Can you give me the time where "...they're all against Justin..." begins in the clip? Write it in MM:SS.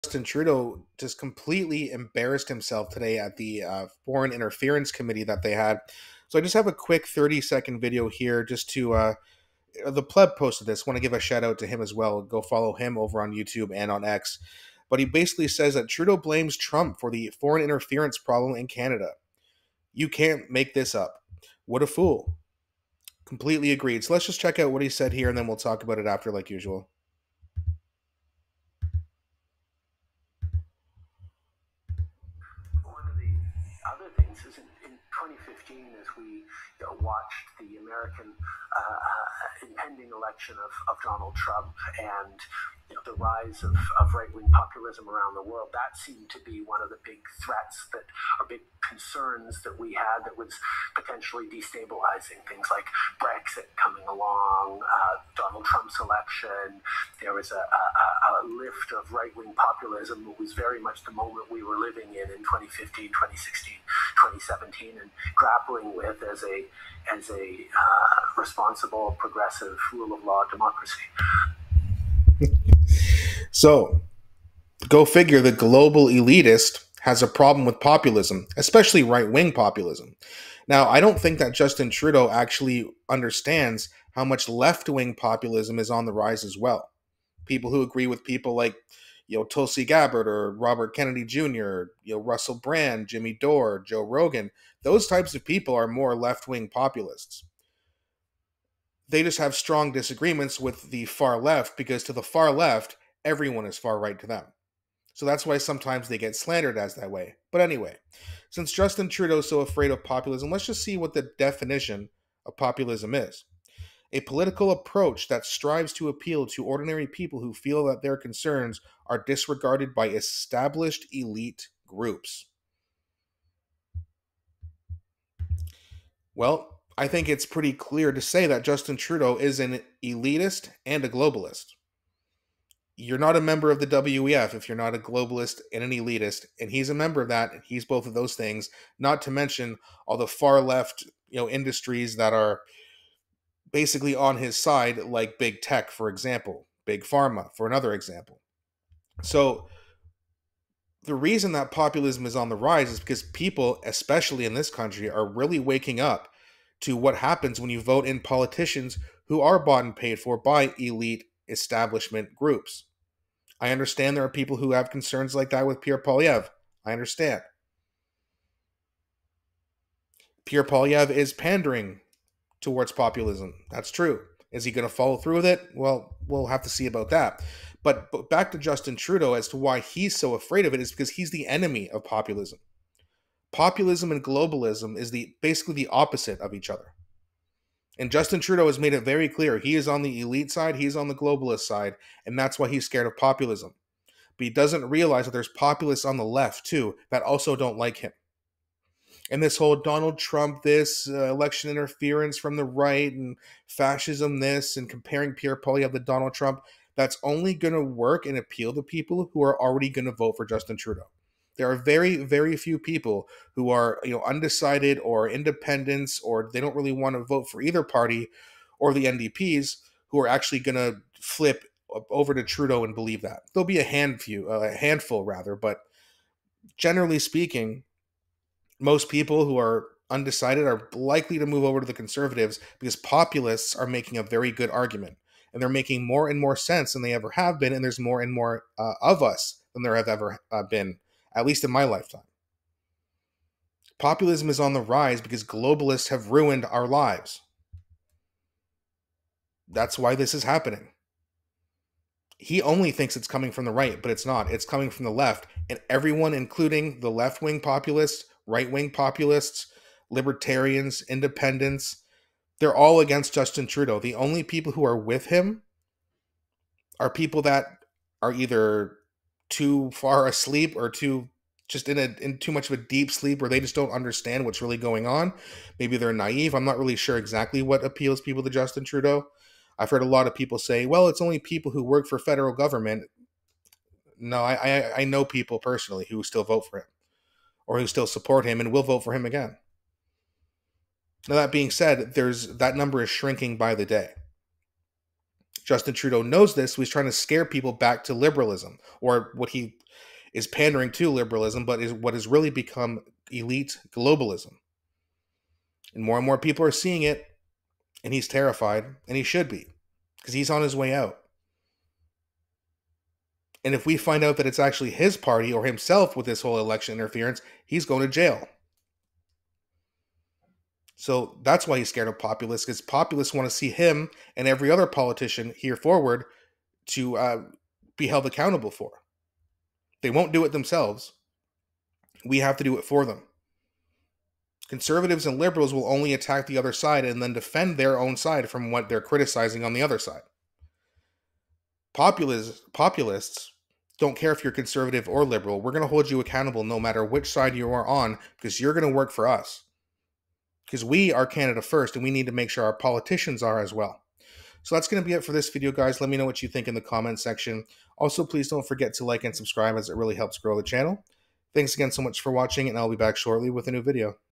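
04:22.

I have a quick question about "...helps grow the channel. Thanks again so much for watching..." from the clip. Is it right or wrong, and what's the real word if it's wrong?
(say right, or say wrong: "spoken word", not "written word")
right.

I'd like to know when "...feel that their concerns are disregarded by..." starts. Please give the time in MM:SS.
01:57.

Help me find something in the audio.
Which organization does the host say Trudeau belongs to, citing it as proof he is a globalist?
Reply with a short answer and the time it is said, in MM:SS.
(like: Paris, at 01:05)
WEF, at 02:13.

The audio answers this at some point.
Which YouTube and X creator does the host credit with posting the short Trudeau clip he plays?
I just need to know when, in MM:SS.
00:09.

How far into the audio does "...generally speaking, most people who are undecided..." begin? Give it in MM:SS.
03:46.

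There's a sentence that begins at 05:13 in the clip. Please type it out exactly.
And if we find out that it's actually his party or himself with this whole election interference, he's going to jail.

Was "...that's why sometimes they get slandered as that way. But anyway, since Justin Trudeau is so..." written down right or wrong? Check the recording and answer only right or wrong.
right.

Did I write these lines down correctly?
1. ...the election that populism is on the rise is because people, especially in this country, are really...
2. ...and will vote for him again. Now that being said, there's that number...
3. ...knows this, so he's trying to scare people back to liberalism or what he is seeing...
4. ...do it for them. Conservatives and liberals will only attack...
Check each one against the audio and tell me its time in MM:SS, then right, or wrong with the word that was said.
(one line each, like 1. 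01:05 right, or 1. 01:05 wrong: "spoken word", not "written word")
1. 02:31 wrong: "reason", not "election"
2. 04:48 right
3. 04:56 wrong: "pandering", not "seeing"
4. 05:32 right.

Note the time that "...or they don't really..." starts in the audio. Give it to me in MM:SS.
03:36.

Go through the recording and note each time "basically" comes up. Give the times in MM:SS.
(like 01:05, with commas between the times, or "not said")
00:15, 02:23, 03:05.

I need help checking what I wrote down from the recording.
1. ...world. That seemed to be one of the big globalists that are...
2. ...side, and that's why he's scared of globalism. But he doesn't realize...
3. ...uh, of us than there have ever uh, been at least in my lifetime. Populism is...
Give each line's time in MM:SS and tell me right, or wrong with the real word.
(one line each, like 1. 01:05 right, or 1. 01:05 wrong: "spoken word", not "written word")
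1. 00:45 wrong: "threats", not "globalists"
2. 03:11 wrong: "populism", not "globalism"
3. 03:58 right.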